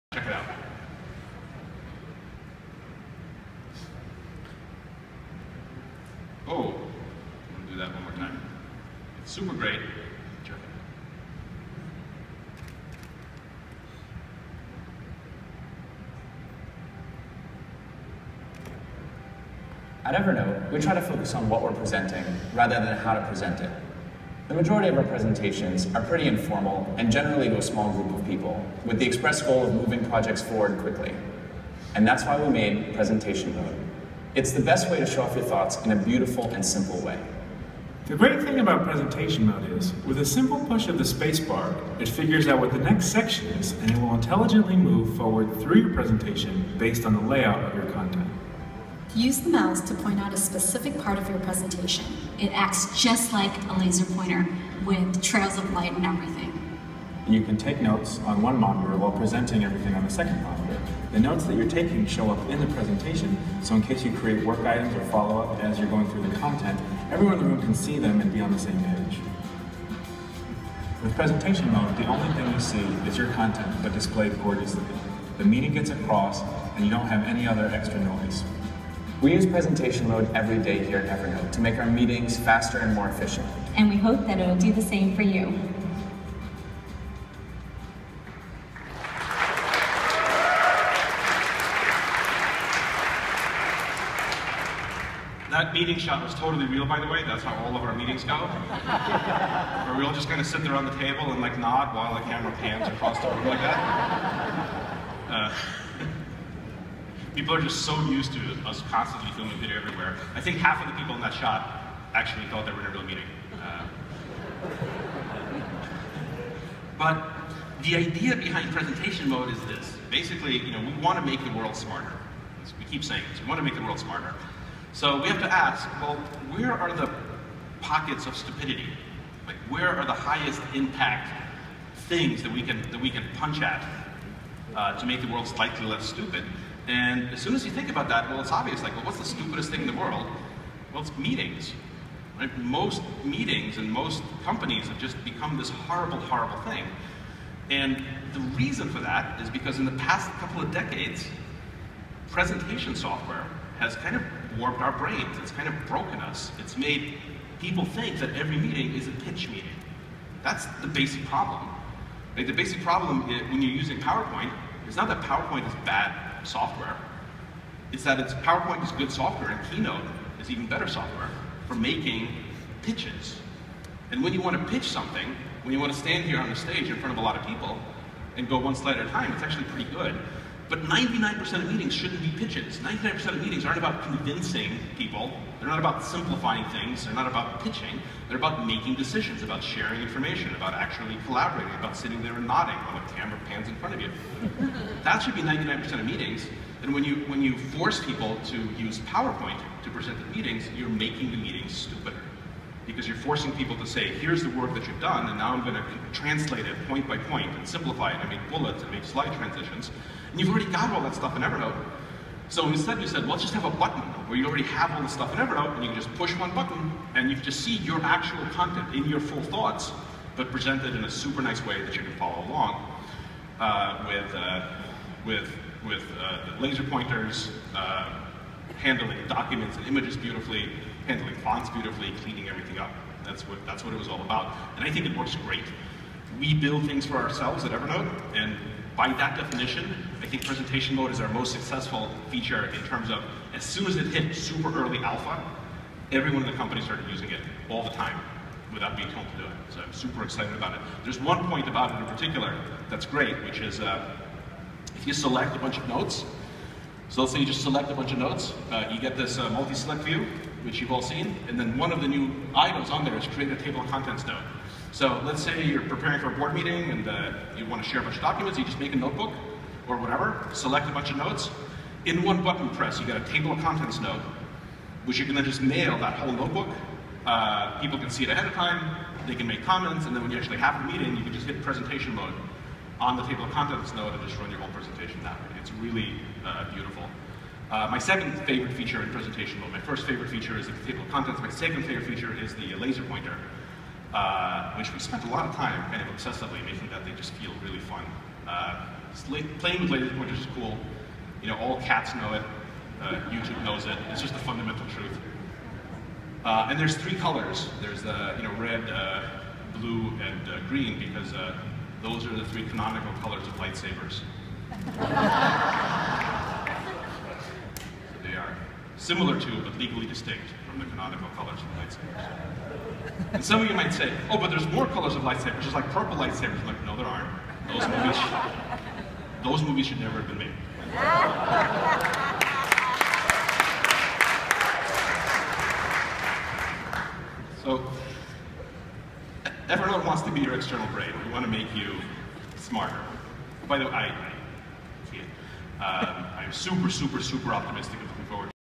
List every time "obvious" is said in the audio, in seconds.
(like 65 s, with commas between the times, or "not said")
138 s.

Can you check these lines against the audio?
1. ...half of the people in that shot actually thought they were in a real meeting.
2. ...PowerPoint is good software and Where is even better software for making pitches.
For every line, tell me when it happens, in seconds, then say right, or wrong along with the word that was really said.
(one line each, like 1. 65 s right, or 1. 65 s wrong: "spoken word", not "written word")
1. 110 s right
2. 168 s wrong: "Keynote", not "Where".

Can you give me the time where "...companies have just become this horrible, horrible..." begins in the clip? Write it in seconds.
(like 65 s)
144 s.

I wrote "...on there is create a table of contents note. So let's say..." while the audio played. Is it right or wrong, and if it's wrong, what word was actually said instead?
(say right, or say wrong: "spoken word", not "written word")
right.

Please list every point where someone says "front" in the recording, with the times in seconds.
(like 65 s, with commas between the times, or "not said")
176 s, 193 s.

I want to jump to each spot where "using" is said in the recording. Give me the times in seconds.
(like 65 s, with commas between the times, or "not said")
163 s, 247 s.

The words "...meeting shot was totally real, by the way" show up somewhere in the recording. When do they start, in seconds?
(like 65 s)
95 s.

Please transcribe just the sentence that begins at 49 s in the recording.
Use the mouse to point out a specific part of your presentation.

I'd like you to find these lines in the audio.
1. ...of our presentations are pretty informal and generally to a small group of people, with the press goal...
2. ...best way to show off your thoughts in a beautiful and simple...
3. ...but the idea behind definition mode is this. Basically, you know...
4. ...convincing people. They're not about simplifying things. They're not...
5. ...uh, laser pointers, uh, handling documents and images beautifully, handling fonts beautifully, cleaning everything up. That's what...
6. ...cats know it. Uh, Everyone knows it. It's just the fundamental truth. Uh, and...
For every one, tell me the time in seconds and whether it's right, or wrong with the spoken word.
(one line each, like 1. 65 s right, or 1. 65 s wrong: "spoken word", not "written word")
1. 24 s wrong: "express", not "press"
2. 34 s right
3. 116 s wrong: "presentation", not "definition"
4. 184 s right
5. 226 s right
6. 301 s wrong: "YouTube", not "Everyone".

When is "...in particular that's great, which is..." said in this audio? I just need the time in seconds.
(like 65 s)
251 s.